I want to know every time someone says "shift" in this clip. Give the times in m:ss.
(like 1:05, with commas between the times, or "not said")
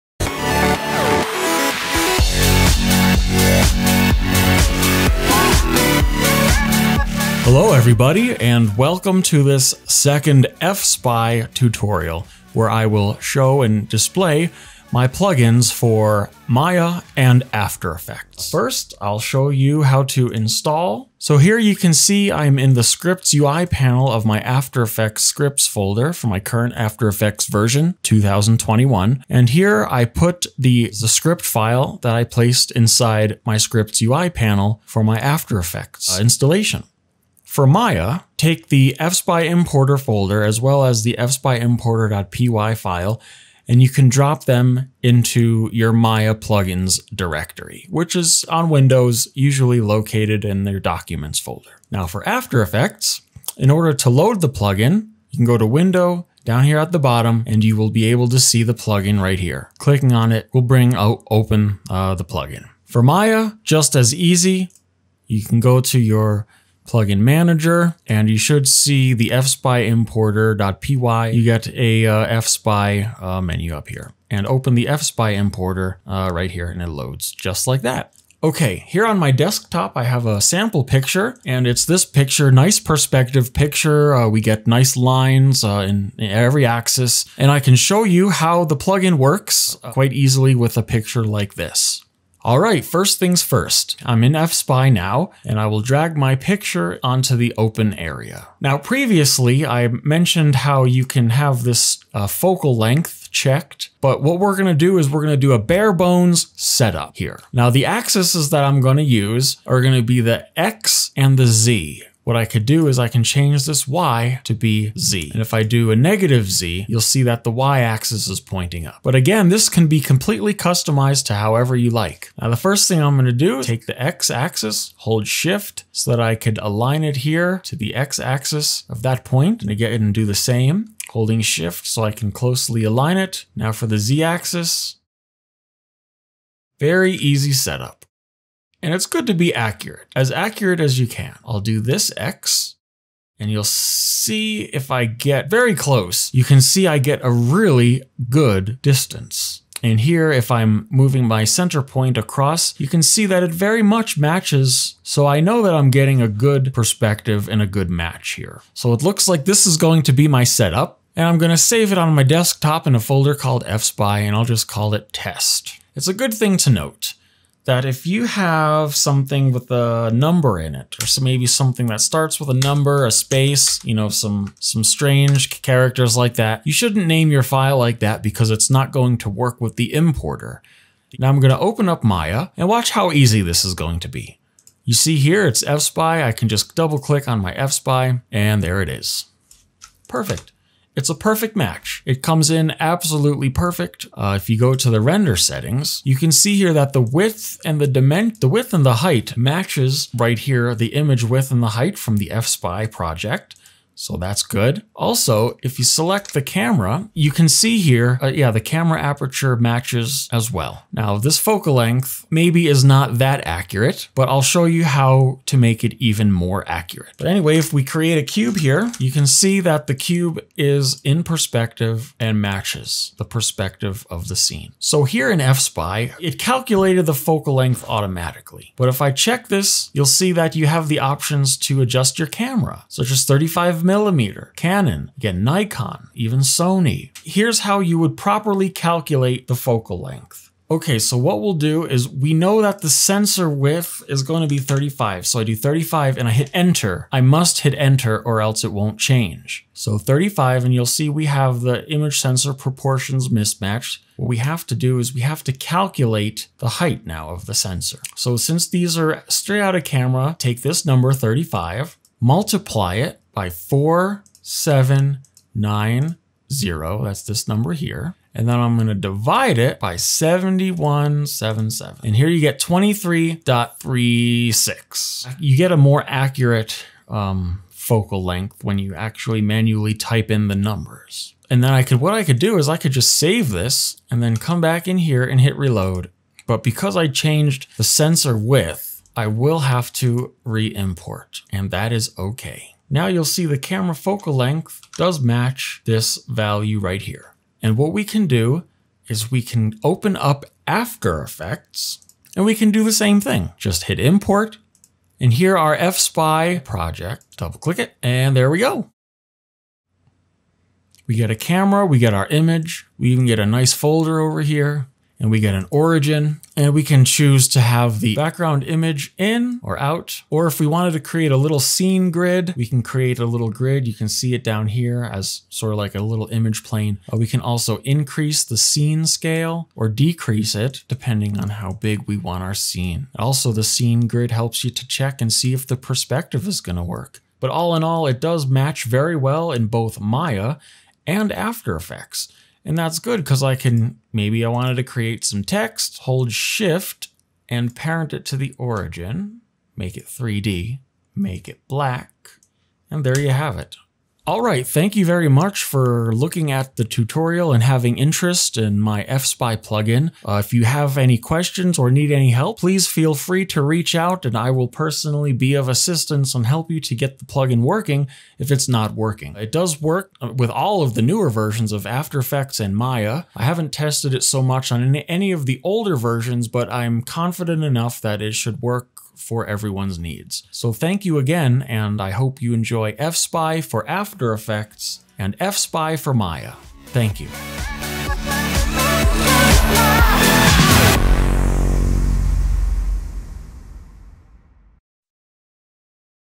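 2:05, 2:11, 5:46.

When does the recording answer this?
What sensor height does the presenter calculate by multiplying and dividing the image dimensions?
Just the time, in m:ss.
4:32.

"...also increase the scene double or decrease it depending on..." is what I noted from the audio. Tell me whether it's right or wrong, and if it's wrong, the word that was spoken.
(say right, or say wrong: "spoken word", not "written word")
wrong: "scale", not "double".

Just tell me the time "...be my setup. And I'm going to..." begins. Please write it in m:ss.
2:40.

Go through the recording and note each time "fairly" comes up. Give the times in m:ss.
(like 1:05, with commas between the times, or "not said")
not said.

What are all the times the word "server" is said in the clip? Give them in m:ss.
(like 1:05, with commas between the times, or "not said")
not said.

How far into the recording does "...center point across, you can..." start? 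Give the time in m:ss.
2:31.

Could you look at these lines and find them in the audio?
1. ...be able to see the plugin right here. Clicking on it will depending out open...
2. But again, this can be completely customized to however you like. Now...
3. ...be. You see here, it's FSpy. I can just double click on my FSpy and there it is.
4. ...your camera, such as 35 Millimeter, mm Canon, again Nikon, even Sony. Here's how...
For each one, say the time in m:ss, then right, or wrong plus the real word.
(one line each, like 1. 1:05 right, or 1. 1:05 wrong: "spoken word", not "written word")
1. 0:57 wrong: "bring", not "depending"
2. 1:59 right
3. 3:04 right
4. 3:52 right.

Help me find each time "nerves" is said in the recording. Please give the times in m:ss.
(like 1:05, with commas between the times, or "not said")
not said.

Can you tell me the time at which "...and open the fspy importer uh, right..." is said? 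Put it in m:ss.
1:14.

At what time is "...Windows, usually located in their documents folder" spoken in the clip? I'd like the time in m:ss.
0:48.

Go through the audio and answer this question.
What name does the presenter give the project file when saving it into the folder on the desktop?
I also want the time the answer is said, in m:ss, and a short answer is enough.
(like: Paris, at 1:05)
test, at 2:45.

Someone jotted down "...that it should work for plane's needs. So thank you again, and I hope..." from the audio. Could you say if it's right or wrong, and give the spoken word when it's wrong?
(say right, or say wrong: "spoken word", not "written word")
wrong: "everyone", not "plane".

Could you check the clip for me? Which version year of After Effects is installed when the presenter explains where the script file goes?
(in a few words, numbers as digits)
2021.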